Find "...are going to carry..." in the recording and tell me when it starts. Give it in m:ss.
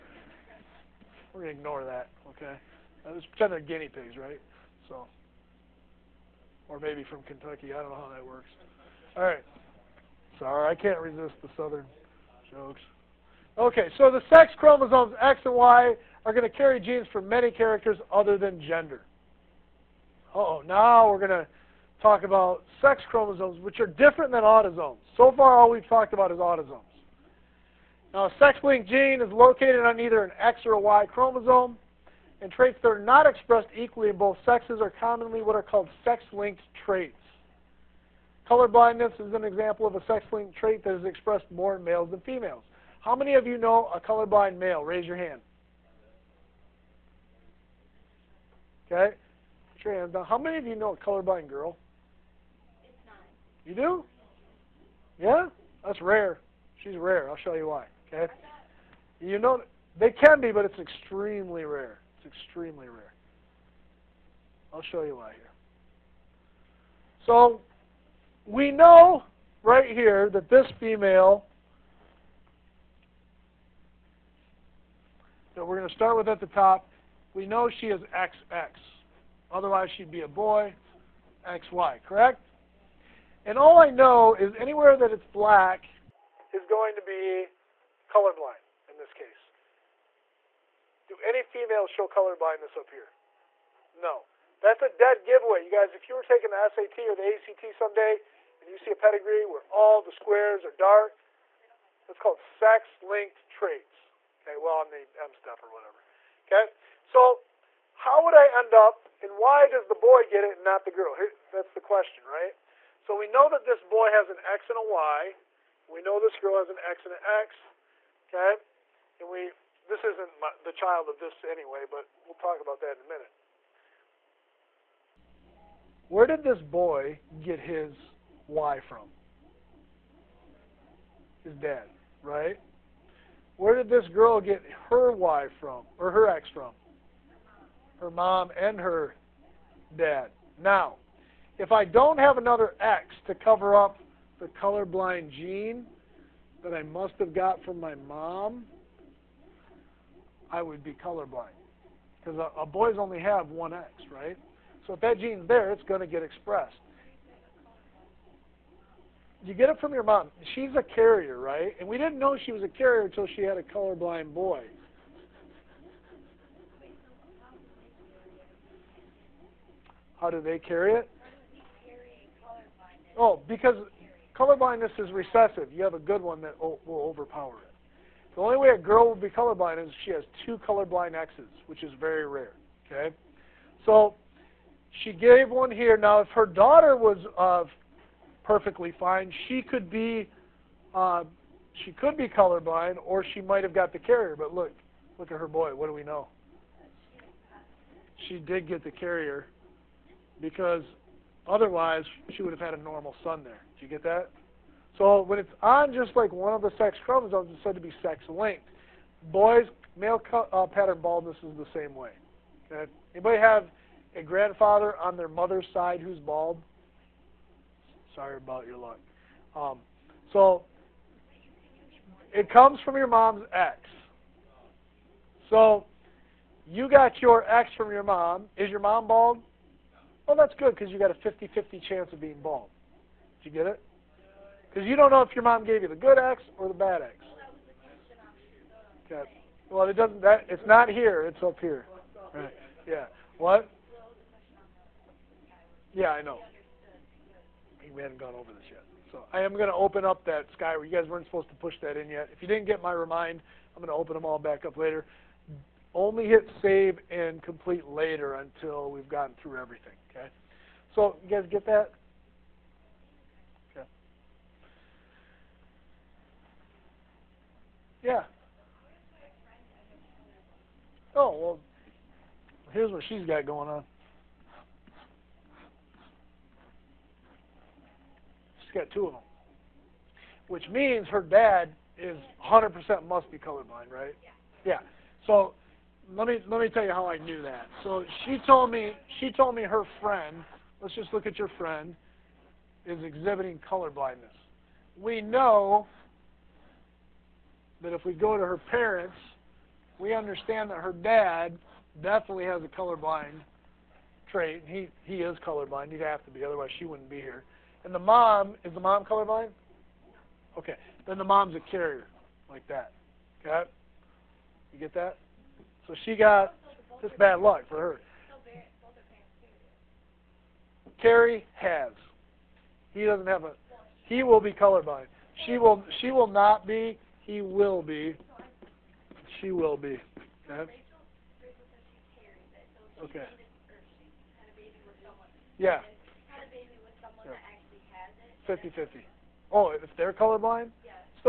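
0:16.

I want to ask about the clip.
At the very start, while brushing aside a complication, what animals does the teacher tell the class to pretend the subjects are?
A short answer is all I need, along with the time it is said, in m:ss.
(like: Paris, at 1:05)
guinea pigs, at 0:03.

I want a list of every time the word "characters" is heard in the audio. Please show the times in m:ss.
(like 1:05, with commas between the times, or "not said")
0:17.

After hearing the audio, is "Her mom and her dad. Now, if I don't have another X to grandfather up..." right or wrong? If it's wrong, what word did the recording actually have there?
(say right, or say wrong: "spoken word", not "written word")
wrong: "cover", not "grandfather".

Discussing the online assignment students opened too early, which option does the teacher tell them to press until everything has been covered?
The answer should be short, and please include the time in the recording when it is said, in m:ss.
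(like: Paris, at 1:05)
save and complete later, at 4:16.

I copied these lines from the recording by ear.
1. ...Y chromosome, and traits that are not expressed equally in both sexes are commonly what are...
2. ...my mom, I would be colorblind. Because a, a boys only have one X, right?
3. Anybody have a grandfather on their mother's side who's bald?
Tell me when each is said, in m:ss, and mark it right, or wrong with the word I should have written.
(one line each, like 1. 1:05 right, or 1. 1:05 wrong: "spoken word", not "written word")
1. 0:30 right
2. 2:27 right
3. 3:33 right.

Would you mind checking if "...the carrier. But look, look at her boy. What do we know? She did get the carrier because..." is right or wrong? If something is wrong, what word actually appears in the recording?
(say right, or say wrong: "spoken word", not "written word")
right.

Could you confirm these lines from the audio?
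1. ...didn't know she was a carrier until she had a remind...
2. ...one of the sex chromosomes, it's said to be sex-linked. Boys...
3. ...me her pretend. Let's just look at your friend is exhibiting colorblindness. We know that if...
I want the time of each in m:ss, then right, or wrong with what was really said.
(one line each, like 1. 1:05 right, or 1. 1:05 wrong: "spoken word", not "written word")
1. 2:41 wrong: "colorblind", not "remind"
2. 3:26 right
3. 4:49 wrong: "friend", not "pretend".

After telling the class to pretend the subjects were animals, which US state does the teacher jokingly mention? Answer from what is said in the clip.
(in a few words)
Kentucky.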